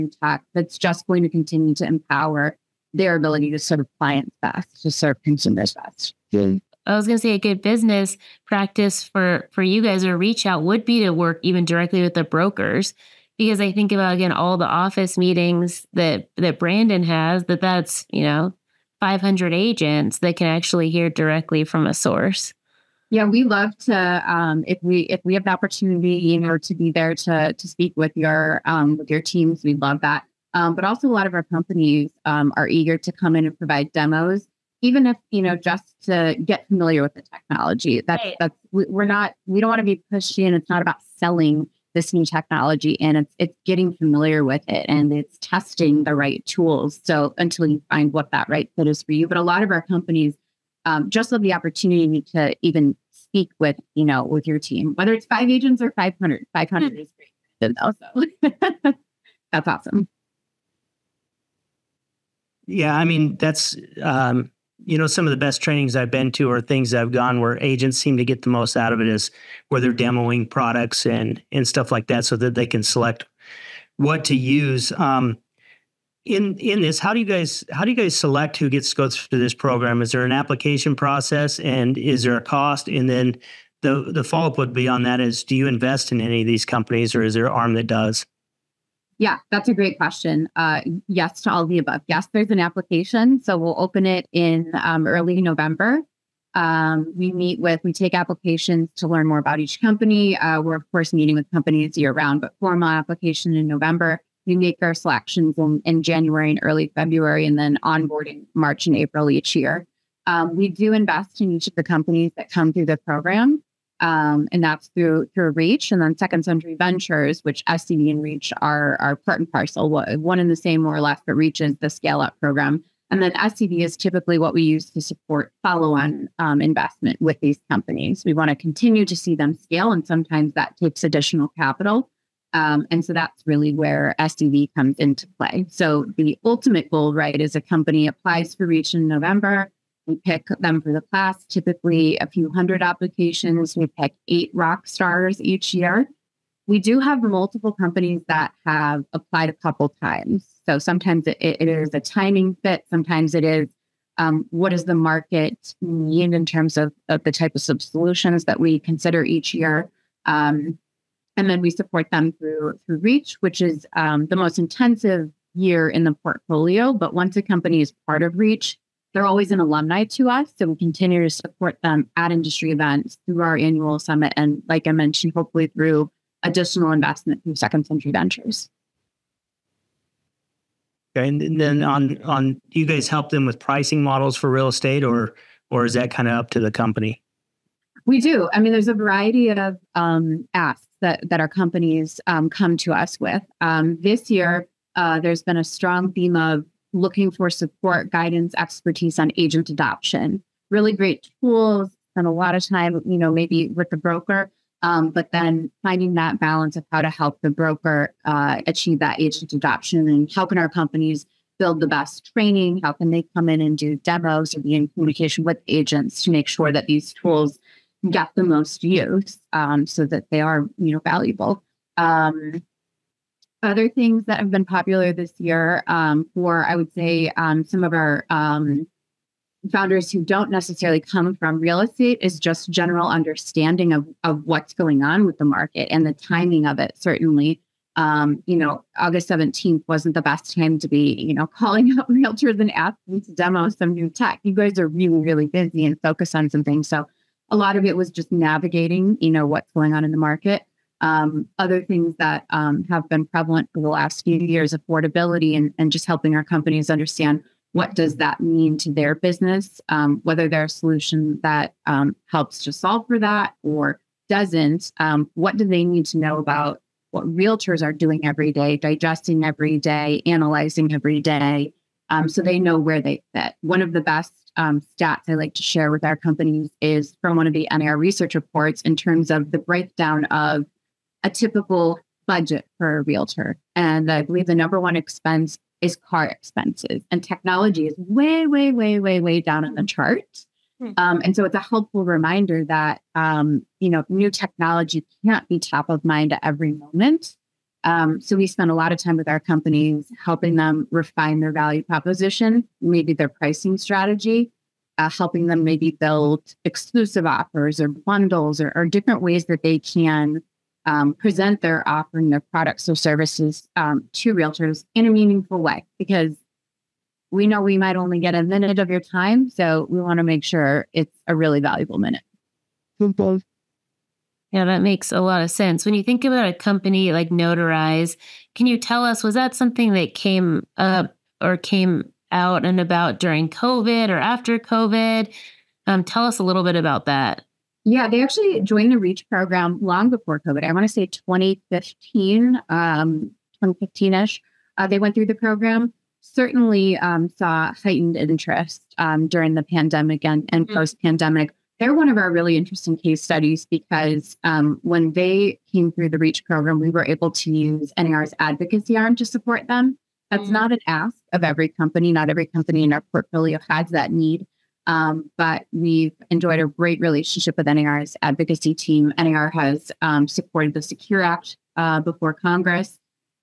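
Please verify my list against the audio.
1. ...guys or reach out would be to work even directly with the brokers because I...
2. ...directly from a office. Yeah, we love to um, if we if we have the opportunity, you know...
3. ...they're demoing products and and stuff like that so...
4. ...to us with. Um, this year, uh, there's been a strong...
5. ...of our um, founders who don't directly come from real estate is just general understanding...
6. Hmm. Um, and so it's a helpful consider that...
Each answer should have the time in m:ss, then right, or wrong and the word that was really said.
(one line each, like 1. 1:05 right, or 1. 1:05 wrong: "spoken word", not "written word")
1. 0:09 right
2. 0:21 wrong: "source", not "office"
3. 1:09 right
4. 3:12 right
5. 3:47 wrong: "necessarily", not "directly"
6. 4:50 wrong: "reminder", not "consider".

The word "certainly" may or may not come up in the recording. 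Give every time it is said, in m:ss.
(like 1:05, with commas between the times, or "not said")
3:56, 5:46.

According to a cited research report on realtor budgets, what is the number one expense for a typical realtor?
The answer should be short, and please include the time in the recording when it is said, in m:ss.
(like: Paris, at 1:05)
Car expenses, at 4:45.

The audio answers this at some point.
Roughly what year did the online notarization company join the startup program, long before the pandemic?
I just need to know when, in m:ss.
5:41.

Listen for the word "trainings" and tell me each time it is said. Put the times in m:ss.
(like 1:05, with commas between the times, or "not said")
1:05, 3:32.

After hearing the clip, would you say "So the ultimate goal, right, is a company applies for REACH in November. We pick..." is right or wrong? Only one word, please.
right.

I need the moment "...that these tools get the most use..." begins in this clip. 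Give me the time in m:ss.
3:36.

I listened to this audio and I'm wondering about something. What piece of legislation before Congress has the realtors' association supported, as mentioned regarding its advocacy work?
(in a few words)
Secure Act.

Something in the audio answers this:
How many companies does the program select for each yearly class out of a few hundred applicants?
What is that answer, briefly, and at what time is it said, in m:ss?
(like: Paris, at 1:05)
8, at 2:24.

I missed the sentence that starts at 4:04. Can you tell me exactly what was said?
You guys are really, really busy and focused on some things.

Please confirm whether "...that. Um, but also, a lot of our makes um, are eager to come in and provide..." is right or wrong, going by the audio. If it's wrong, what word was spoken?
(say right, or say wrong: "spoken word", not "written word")
wrong: "companies", not "makes".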